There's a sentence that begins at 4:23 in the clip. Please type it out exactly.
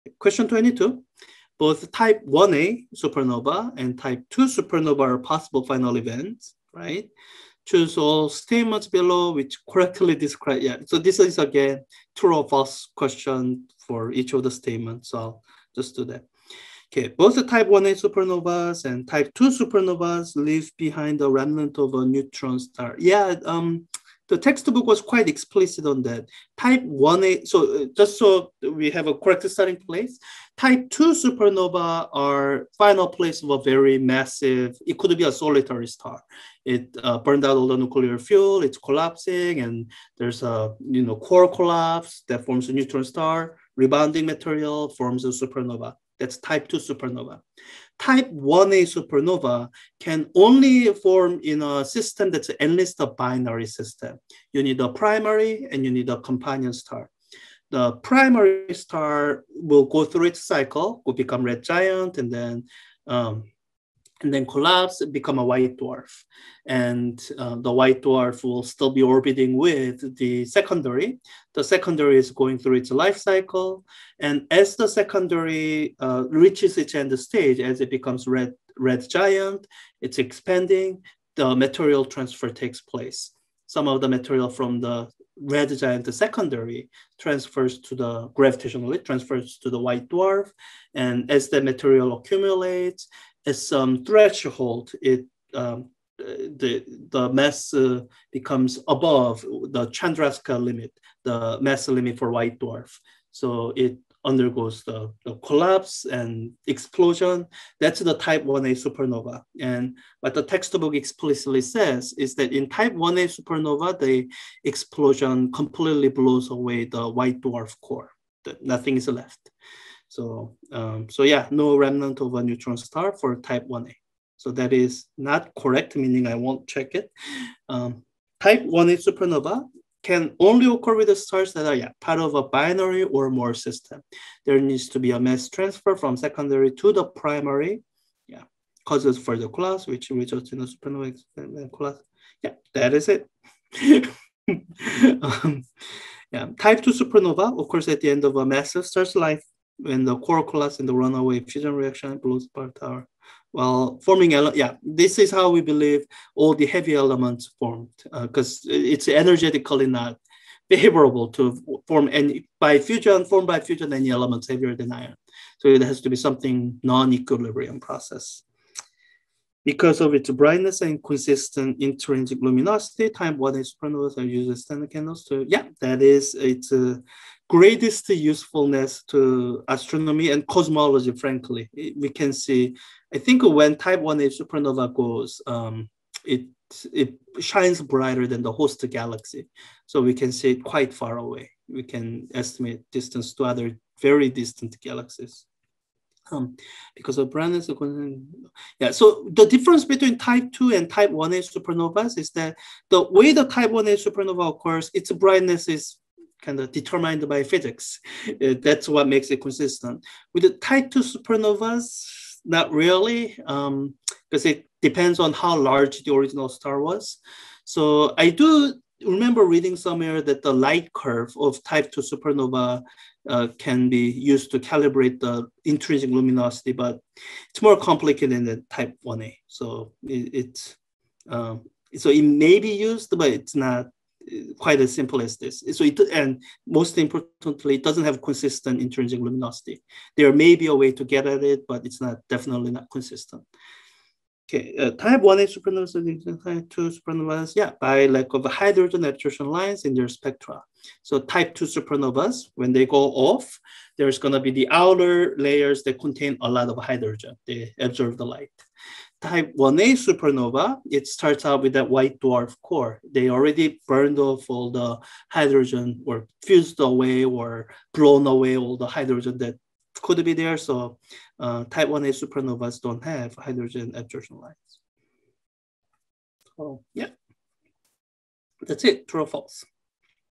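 They already burned off all the hydrogen or fused away or blown away all the hydrogen that could be there.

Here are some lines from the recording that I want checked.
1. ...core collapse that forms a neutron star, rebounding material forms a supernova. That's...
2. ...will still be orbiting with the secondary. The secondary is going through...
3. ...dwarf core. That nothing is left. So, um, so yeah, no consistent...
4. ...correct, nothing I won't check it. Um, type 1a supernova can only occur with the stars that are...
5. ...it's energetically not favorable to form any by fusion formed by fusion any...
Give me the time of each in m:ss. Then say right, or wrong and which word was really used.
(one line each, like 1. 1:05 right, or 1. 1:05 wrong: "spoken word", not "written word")
1. 0:41 right
2. 1:08 right
3. 1:57 wrong: "remnant", not "consistent"
4. 2:05 wrong: "meaning", not "nothing"
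5. 2:38 right.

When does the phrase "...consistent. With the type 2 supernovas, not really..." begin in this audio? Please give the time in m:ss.
3:29.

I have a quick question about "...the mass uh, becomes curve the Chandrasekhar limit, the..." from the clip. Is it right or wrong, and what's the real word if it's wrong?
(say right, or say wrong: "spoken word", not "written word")
wrong: "above", not "curve".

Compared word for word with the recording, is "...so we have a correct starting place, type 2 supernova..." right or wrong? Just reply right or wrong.
right.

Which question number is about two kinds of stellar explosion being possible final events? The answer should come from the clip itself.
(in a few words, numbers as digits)
22.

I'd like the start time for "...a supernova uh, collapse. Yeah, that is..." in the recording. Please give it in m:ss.
2:20.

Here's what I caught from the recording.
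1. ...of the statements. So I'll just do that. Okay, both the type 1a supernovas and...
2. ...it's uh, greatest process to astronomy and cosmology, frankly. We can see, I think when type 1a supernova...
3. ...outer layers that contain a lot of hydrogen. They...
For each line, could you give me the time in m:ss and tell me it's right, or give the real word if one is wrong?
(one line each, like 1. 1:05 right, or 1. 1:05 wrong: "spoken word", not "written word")
1. 0:14 right
2. 2:56 wrong: "usefulness", not "process"
3. 4:14 right.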